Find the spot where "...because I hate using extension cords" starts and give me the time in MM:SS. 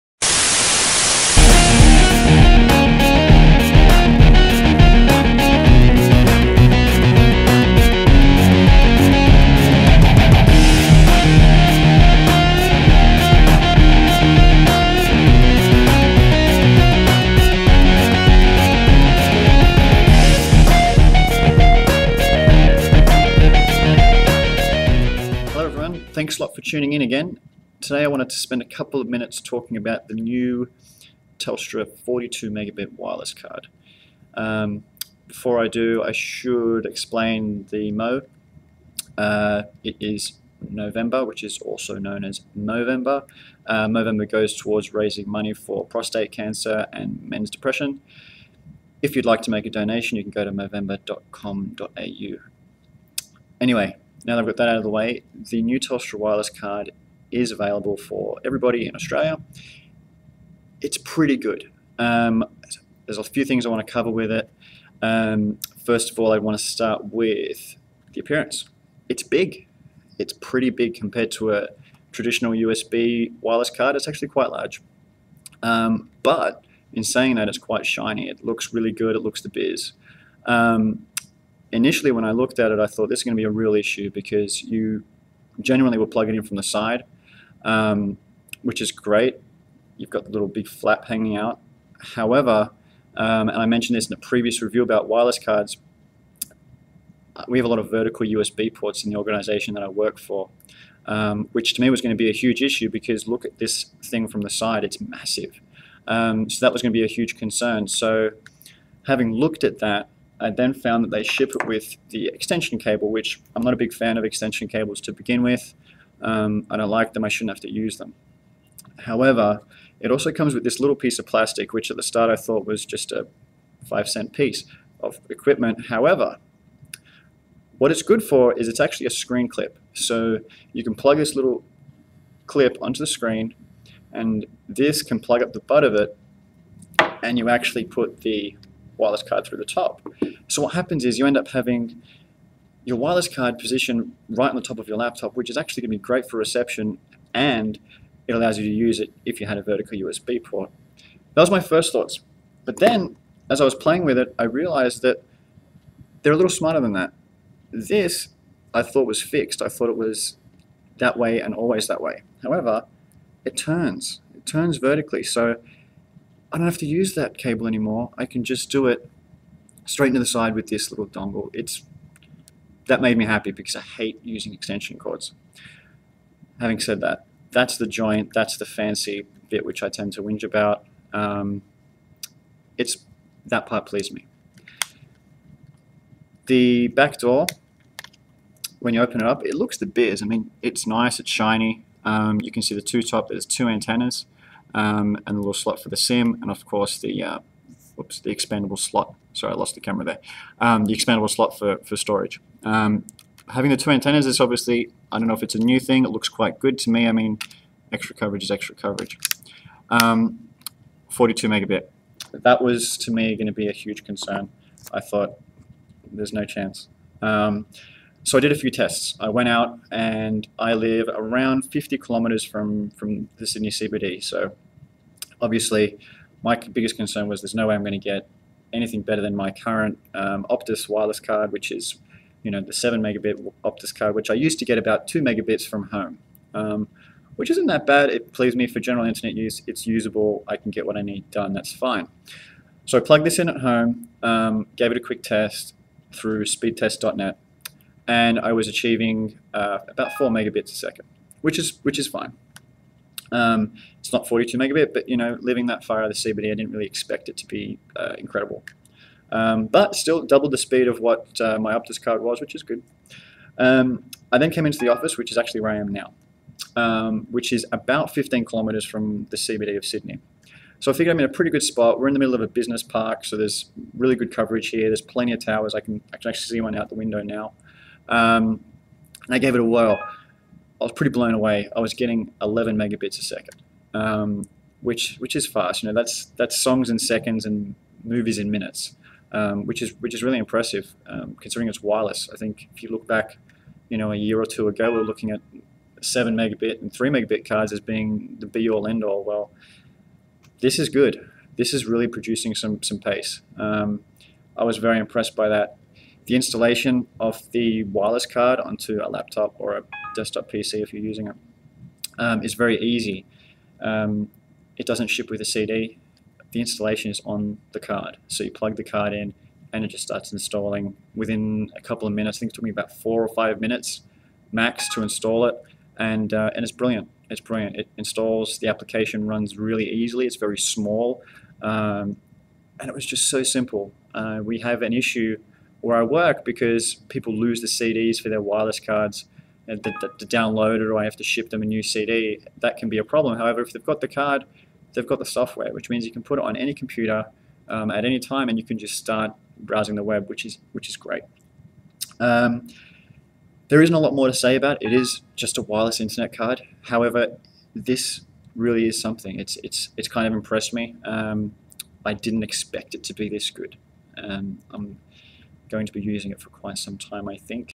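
02:53.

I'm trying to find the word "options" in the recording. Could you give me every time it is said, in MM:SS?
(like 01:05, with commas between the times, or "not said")
not said.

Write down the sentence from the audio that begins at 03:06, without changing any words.
The back door, when you open it up, it looks the biz.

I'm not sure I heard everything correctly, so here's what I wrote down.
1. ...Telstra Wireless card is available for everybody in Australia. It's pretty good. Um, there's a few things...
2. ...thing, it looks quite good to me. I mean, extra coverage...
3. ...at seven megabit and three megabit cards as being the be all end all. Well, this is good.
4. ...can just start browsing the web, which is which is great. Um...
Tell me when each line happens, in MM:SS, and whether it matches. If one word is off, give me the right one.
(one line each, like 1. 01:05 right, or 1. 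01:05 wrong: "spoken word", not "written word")
1. 00:55 right
2. 03:25 right
3. 04:55 right
4. 05:48 right.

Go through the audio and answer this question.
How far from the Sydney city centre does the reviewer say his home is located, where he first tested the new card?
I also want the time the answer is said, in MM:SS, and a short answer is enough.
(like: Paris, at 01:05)
50 kilometers, at 03:41.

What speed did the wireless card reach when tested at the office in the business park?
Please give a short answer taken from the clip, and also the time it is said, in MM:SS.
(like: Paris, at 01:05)
11 megabits a second, at 04:42.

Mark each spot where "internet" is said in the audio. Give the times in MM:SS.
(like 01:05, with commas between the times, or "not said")
03:59, 05:55.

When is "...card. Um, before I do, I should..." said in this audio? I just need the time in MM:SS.
00:33.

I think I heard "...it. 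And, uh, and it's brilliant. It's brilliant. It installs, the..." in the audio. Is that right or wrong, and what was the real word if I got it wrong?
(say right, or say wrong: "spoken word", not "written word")
right.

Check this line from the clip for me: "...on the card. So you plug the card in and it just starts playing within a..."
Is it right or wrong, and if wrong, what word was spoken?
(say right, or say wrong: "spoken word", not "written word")
wrong: "installing", not "playing".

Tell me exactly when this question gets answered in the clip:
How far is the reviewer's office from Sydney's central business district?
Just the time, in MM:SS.
04:28.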